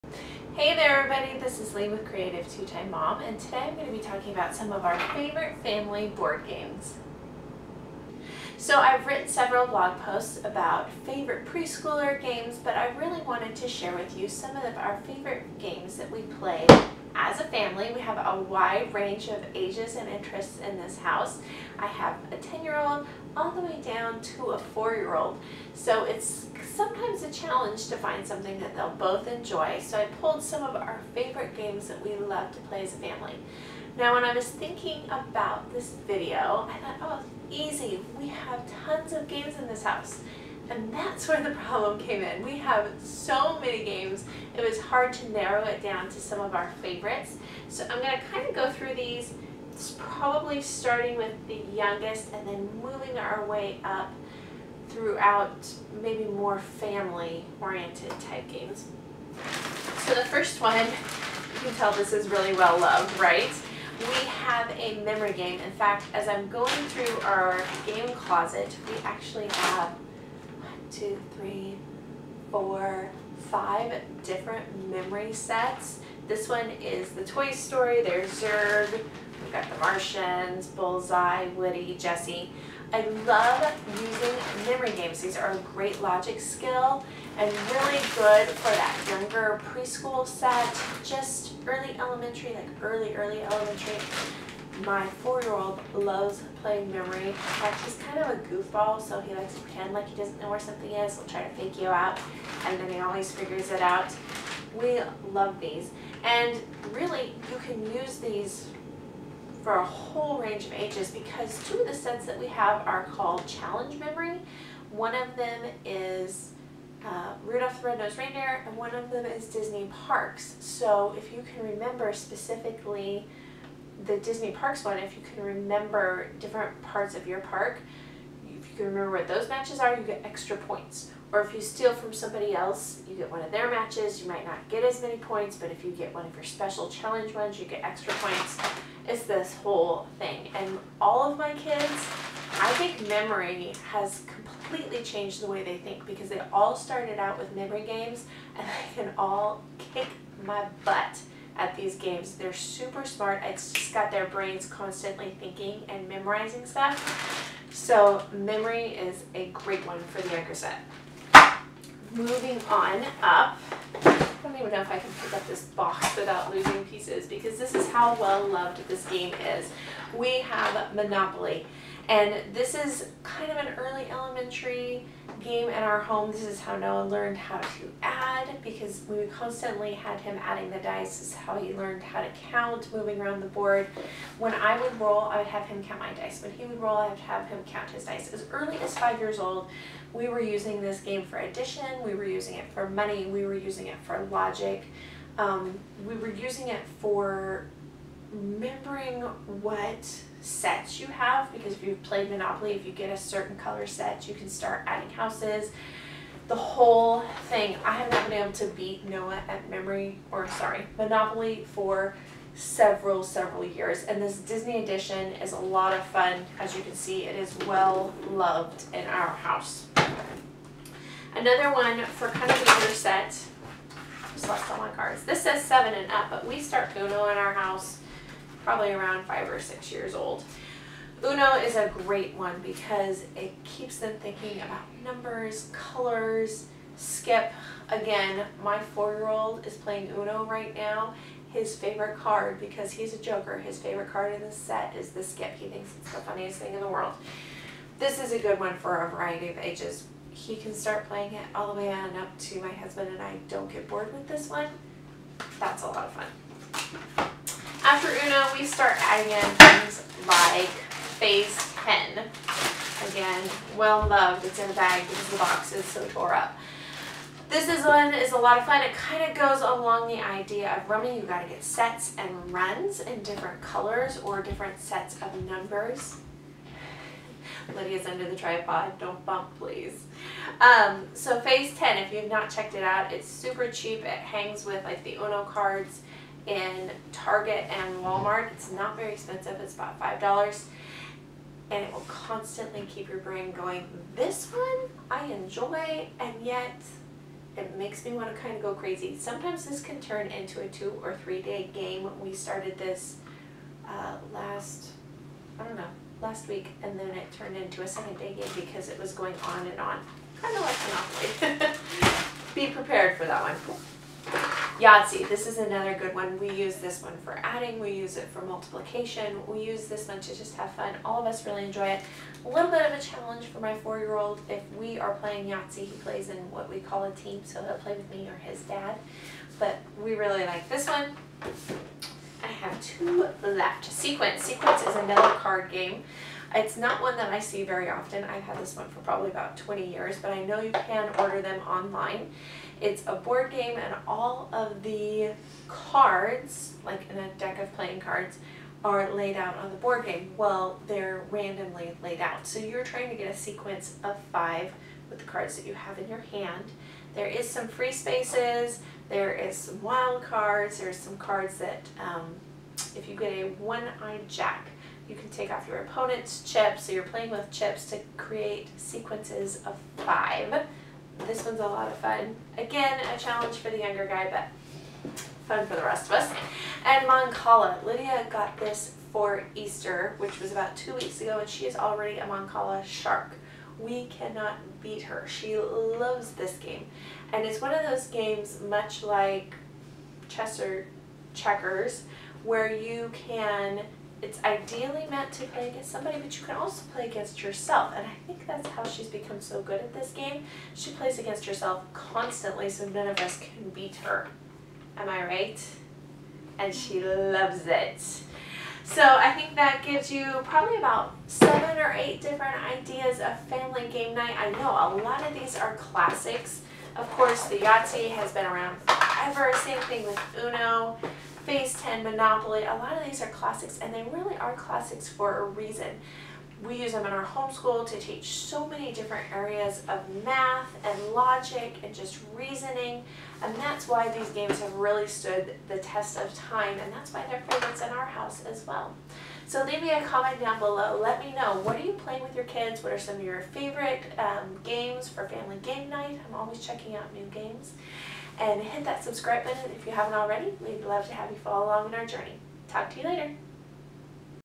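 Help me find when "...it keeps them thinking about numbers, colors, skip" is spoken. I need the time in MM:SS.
03:53.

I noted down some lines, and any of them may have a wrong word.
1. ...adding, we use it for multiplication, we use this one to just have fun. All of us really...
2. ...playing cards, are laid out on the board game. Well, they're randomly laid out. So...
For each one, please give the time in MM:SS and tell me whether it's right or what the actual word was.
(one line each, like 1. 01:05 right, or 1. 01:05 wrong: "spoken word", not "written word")
1. 05:17 right
2. 05:47 right.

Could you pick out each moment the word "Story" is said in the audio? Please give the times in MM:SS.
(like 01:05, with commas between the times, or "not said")
01:17.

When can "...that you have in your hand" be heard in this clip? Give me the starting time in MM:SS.
05:55.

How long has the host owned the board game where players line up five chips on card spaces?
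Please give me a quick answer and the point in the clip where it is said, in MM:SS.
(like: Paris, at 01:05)
about 20 years, at 05:39.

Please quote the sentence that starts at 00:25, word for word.
So it's sometimes a challenge to find something that they'll both enjoy.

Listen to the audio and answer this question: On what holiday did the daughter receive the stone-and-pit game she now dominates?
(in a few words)
Easter.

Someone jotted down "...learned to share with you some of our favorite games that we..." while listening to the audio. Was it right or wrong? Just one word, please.
wrong.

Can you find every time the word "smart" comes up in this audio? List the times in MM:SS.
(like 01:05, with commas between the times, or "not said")
02:33.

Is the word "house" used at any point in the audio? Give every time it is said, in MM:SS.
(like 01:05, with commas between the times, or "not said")
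00:20, 00:39, 03:25, 03:39, 03:47, 07:18.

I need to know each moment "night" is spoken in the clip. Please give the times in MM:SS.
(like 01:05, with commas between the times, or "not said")
06:54, 07:25.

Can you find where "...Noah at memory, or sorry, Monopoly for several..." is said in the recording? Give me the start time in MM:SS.
03:29.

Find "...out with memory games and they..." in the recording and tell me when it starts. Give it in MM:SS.
02:27.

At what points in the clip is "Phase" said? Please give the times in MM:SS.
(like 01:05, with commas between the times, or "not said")
04:21, 04:41, 07:01.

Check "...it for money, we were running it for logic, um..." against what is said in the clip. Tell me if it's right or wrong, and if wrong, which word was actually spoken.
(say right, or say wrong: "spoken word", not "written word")
wrong: "using", not "running".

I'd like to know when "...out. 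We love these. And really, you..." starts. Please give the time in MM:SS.
01:43.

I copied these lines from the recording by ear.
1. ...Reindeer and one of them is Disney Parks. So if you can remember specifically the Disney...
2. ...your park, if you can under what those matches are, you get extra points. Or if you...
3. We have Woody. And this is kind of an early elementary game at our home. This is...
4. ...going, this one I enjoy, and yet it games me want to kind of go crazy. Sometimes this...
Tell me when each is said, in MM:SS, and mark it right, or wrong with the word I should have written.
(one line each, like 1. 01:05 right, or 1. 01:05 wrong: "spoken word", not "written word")
1. 01:58 right
2. 02:07 wrong: "remember", not "under"
3. 02:50 wrong: "Monopoly", not "Woody"
4. 04:53 wrong: "makes", not "games".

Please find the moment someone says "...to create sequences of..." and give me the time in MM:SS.
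06:07.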